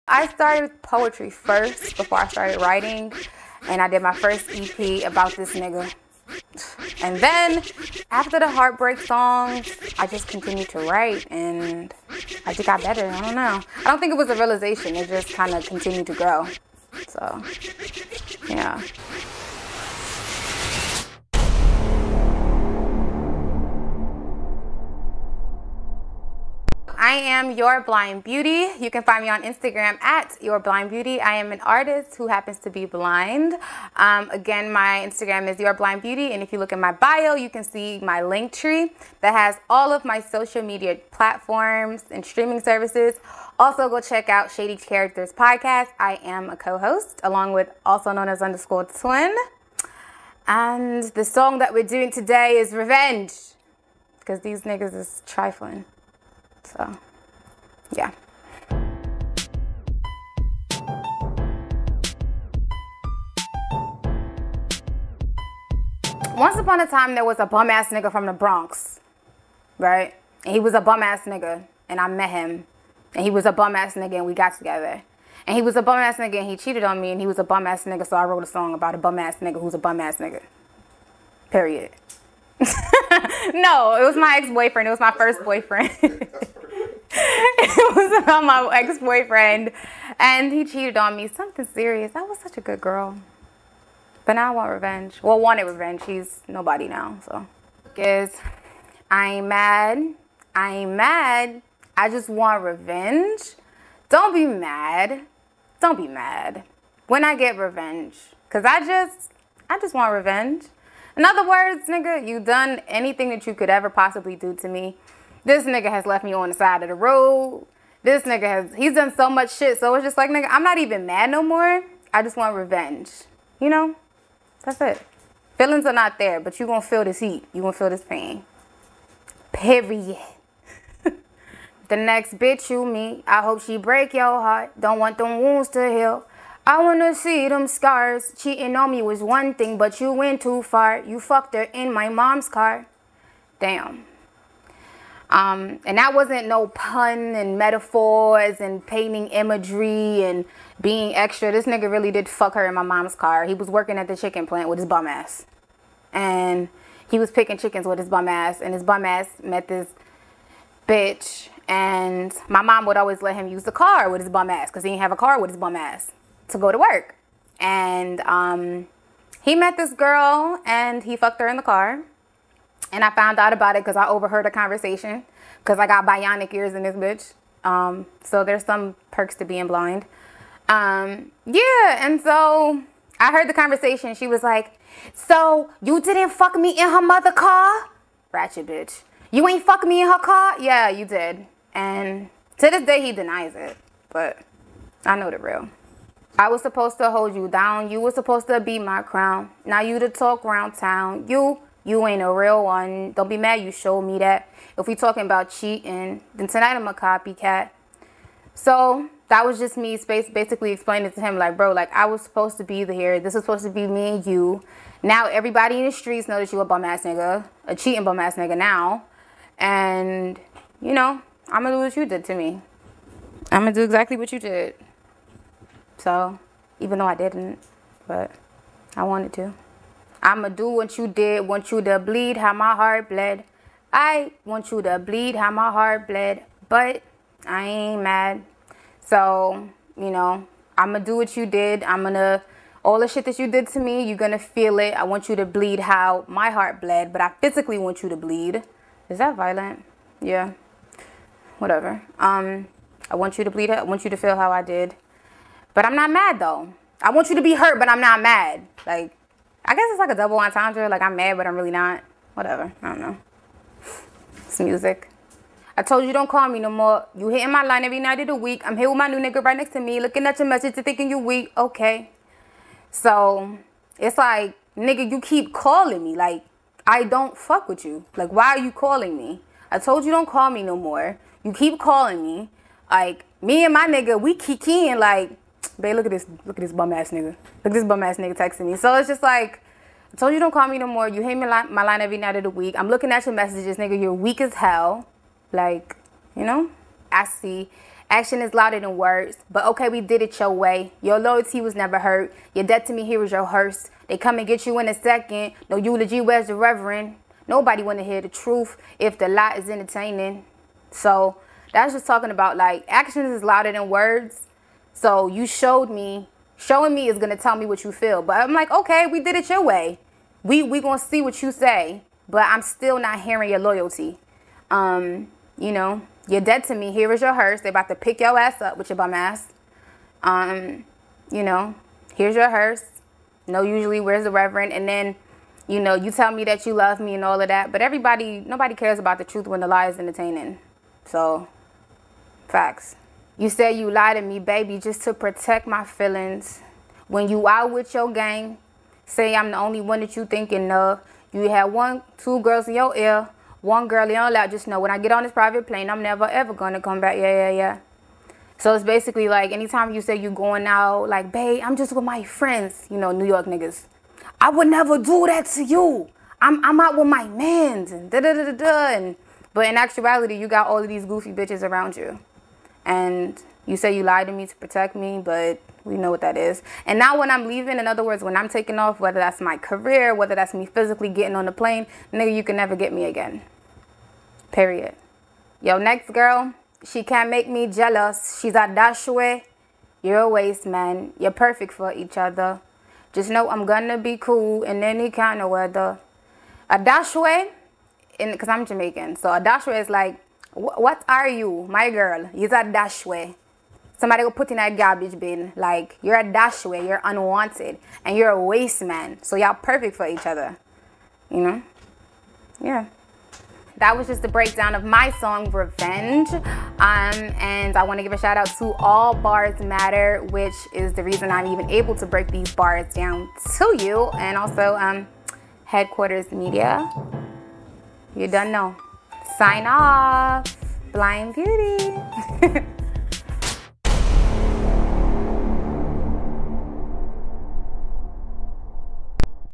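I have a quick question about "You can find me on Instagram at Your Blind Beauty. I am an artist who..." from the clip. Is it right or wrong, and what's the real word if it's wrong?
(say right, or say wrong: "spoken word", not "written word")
right.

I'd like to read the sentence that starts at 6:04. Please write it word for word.
I would never do that to you.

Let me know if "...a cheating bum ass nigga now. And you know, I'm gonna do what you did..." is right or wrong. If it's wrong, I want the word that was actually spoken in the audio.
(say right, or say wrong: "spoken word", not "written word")
right.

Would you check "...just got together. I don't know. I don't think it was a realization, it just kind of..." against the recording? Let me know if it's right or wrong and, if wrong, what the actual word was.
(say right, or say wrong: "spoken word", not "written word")
wrong: "better", not "together".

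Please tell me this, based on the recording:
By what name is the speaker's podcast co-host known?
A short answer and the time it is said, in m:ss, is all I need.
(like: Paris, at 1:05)
Underscore Twin, at 0:48.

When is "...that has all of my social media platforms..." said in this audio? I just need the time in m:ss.
0:39.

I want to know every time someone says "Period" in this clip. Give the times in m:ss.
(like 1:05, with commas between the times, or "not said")
1:21, 2:09, 6:24.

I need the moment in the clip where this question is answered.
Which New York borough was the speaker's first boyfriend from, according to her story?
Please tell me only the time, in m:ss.
1:08.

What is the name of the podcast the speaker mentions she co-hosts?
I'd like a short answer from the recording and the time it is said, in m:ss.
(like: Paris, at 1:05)
Shady Characters, at 0:44.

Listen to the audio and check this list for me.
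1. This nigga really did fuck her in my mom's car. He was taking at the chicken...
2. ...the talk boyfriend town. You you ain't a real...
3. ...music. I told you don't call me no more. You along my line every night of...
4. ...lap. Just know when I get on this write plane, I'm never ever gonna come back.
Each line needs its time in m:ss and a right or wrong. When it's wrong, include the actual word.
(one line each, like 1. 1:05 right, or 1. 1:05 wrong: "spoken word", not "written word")
1. 2:31 wrong: "working", not "taking"
2. 3:19 wrong: "round", not "boyfriend"
3. 4:24 wrong: "hitting", not "along"
4. 5:54 wrong: "private", not "write".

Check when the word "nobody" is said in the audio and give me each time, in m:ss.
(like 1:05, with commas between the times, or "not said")
1:36, 5:07, 5:38.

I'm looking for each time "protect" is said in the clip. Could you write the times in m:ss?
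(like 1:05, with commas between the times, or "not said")
5:45, 6:14.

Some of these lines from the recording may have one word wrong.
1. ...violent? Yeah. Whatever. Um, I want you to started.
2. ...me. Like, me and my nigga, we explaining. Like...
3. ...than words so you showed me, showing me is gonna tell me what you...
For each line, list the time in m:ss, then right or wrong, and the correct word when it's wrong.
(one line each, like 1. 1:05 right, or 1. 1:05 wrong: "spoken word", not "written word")
1. 4:09 wrong: "bleed", not "started"
2. 4:42 wrong: "kicking", not "explaining"
3. 5:13 right.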